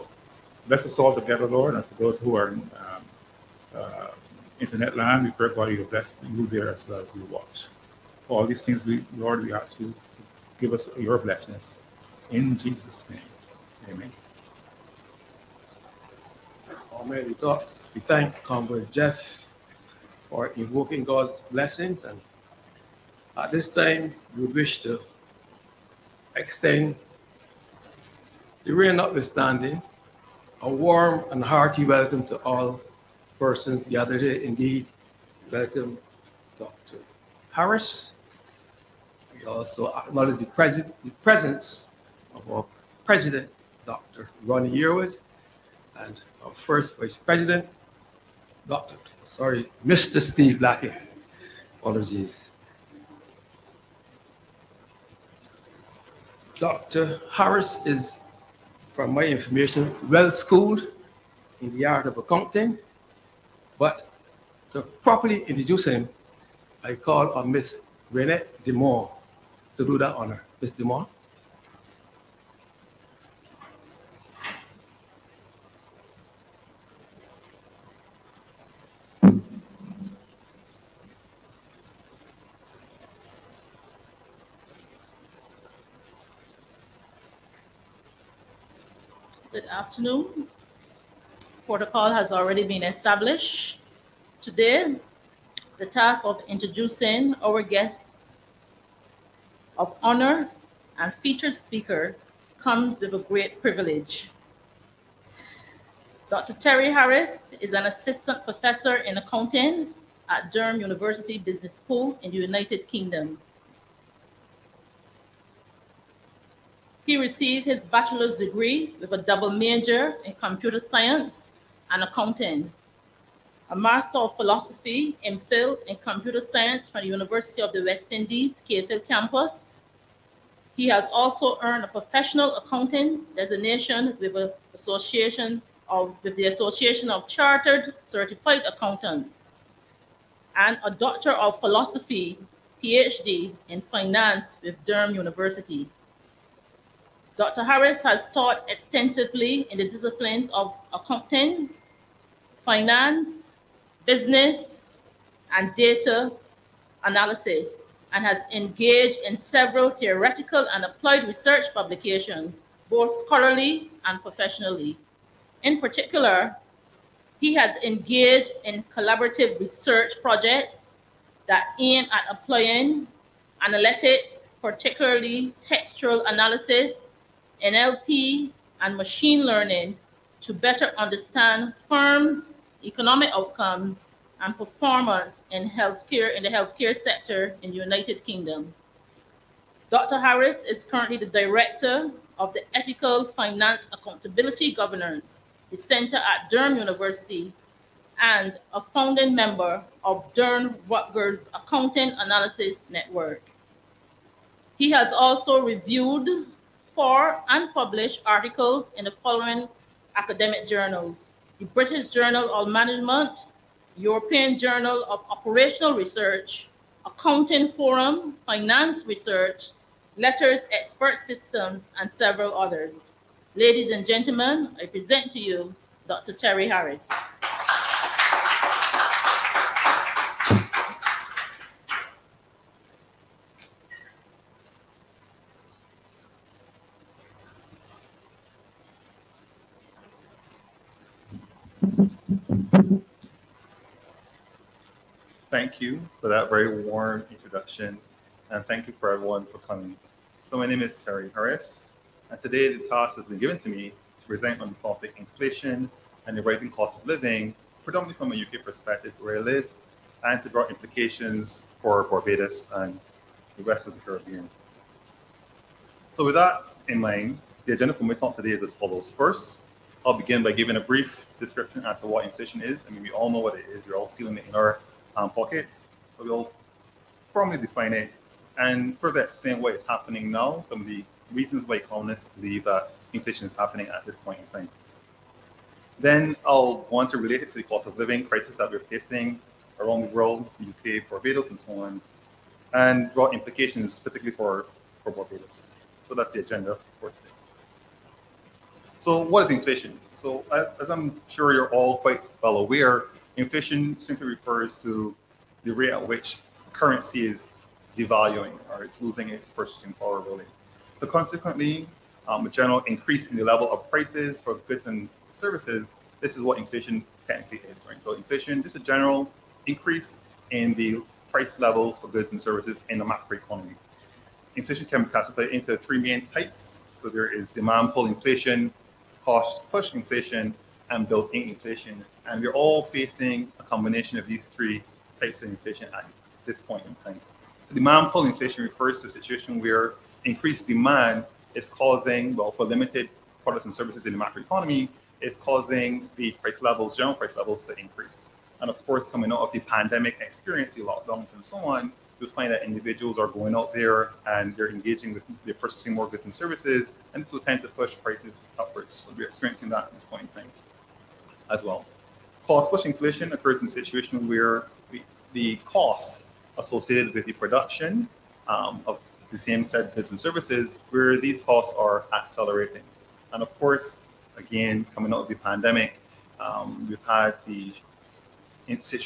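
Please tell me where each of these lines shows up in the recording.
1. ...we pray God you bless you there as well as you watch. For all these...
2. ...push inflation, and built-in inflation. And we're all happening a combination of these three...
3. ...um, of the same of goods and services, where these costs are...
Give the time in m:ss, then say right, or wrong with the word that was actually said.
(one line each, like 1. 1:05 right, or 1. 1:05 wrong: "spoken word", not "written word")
1. 0:05 right
2. 5:29 wrong: "facing", not "happening"
3. 6:08 right.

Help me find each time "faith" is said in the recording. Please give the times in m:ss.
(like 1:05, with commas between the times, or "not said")
not said.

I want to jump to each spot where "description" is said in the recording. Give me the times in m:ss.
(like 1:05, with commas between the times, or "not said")
4:31.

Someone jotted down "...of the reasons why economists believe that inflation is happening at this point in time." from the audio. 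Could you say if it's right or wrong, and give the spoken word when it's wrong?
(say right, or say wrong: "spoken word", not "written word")
right.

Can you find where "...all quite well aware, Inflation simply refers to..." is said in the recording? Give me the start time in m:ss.
5:01.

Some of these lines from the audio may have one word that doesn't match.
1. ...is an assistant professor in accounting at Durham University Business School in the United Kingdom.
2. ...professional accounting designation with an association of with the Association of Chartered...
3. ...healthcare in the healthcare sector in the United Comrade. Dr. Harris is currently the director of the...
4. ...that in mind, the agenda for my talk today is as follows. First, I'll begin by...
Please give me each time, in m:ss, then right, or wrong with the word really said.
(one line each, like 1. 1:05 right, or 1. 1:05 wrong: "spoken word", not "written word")
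1. 1:47 right
2. 2:11 right
3. 3:05 wrong: "Kingdom", not "Comrade"
4. 4:26 right.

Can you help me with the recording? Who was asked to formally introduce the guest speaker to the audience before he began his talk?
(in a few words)
Renette DeMore.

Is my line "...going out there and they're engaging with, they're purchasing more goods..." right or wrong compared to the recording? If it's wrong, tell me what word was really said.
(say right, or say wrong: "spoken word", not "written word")
right.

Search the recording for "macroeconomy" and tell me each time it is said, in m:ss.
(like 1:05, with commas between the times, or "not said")
5:23, 5:44.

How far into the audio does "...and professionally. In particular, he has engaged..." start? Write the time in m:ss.
2:44.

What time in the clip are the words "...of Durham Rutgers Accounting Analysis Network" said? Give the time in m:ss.
3:20.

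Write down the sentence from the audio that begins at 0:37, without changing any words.
Harris, we also acknowledge the, pres the presence of our president, Dr.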